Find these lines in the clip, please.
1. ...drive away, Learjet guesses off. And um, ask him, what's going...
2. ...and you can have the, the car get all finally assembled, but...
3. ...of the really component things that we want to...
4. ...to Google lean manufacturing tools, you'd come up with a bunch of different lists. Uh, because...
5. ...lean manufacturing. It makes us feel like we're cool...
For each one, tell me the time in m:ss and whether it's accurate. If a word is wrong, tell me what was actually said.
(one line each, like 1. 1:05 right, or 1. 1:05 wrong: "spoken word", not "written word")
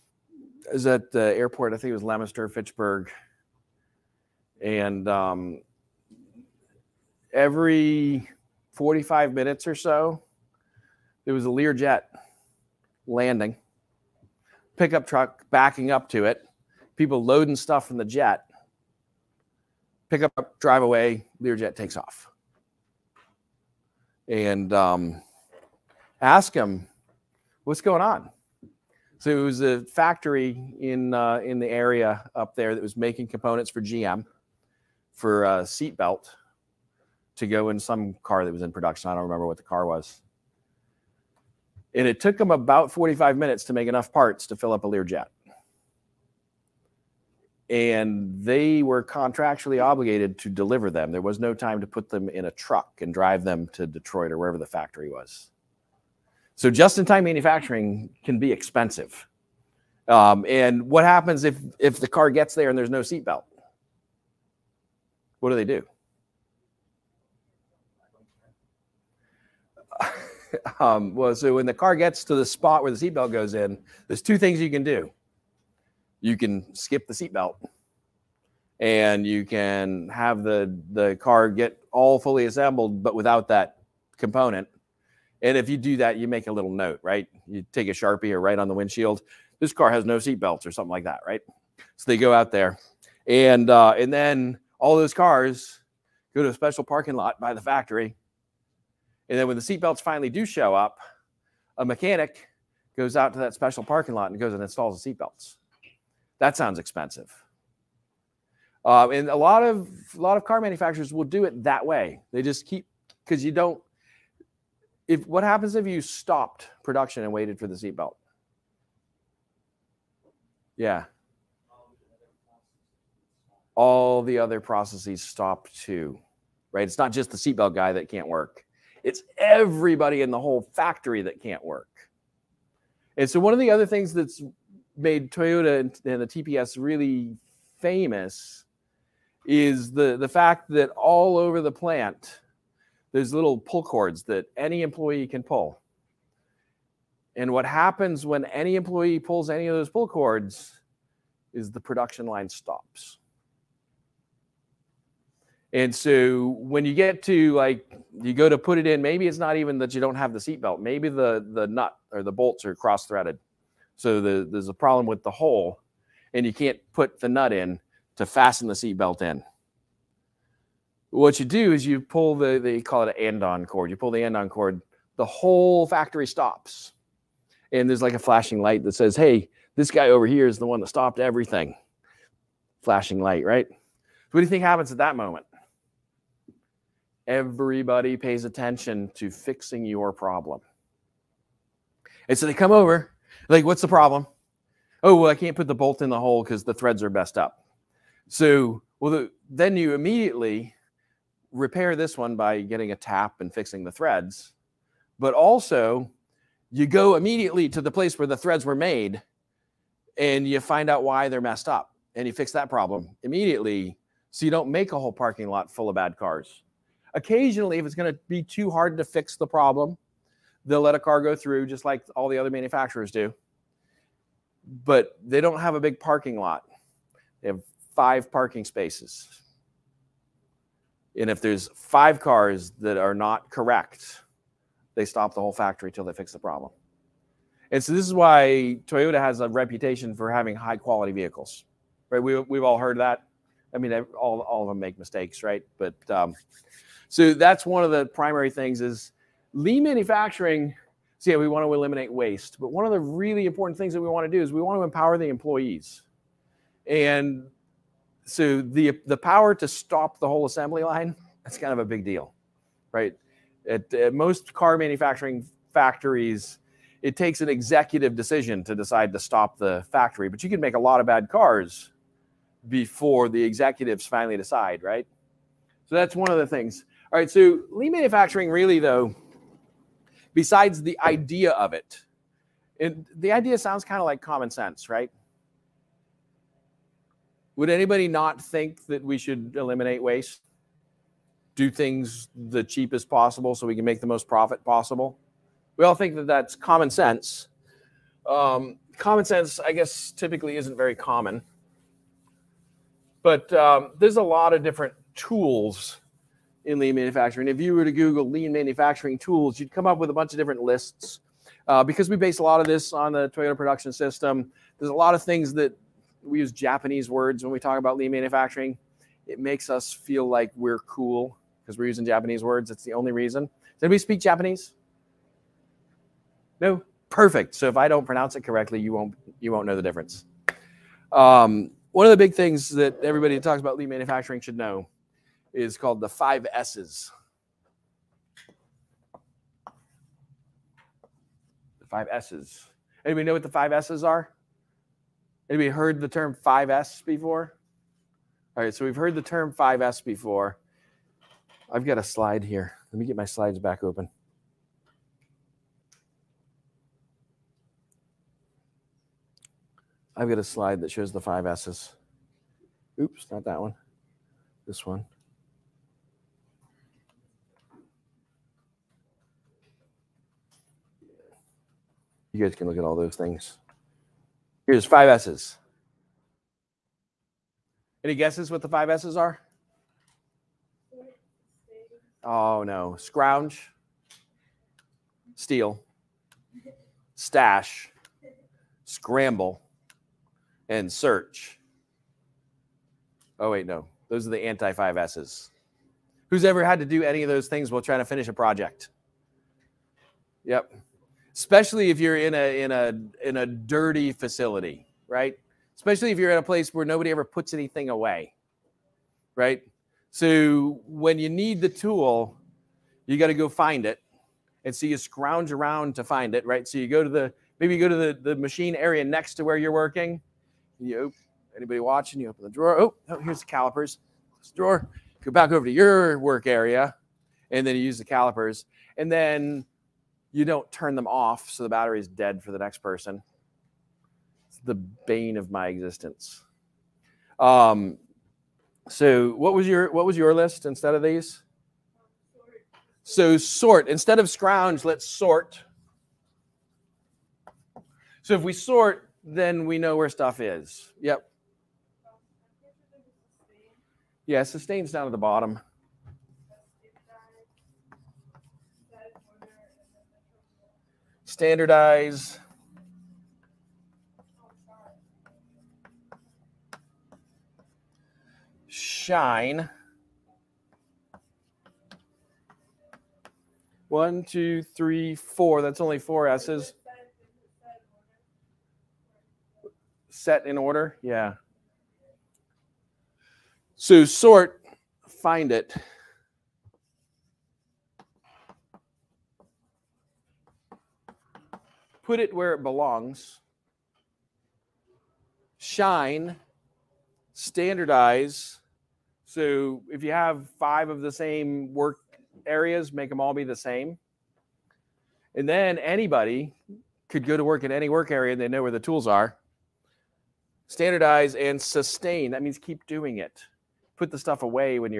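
1. 0:20 wrong: "takes", not "guesses"
2. 1:18 wrong: "fully", not "finally"
3. 4:12 wrong: "important", not "component"
4. 5:07 right
5. 5:17 right.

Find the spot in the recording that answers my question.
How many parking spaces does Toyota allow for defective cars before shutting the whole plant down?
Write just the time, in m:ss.
3:47.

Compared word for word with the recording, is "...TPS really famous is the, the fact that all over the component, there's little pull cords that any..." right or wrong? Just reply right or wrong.
wrong.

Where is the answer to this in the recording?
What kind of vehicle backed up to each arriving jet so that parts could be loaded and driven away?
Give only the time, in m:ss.
0:14.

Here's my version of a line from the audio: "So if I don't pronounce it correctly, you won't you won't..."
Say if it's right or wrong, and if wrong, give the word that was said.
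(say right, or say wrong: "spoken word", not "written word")
right.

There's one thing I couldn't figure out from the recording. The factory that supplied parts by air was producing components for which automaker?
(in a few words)
GM.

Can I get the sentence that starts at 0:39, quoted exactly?
I don't remember what the car was.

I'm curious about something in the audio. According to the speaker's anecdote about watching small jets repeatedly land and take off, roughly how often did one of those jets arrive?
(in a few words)
every 45 minutes.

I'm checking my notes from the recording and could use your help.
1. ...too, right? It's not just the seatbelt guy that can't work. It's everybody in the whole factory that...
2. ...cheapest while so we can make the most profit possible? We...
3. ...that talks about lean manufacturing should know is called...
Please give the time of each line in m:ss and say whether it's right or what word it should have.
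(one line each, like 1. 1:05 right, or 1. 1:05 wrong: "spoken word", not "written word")
1. 2:05 right
2. 4:52 wrong: "possible", not "while"
3. 5:33 right.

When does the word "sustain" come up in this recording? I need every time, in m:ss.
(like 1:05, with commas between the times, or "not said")
7:34, 8:31.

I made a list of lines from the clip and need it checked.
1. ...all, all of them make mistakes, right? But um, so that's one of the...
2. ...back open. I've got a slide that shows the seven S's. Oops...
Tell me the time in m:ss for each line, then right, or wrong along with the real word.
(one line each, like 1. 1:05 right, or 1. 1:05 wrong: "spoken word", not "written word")
1. 4:03 right
2. 5:53 wrong: "five", not "seven".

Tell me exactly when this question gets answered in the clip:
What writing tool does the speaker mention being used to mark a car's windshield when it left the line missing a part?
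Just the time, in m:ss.
1:27.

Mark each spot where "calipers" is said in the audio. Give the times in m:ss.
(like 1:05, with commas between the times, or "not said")
7:03, 7:08.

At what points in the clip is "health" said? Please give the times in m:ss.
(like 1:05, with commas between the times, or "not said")
not said.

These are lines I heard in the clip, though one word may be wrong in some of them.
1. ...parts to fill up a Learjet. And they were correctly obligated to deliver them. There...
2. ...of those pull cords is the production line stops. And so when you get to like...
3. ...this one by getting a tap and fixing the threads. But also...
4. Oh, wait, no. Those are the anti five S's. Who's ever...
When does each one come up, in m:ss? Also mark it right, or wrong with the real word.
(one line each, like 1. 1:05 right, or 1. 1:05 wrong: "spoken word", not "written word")
1. 0:44 wrong: "contractually", not "correctly"
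2. 2:29 right
3. 3:21 right
4. 6:33 right.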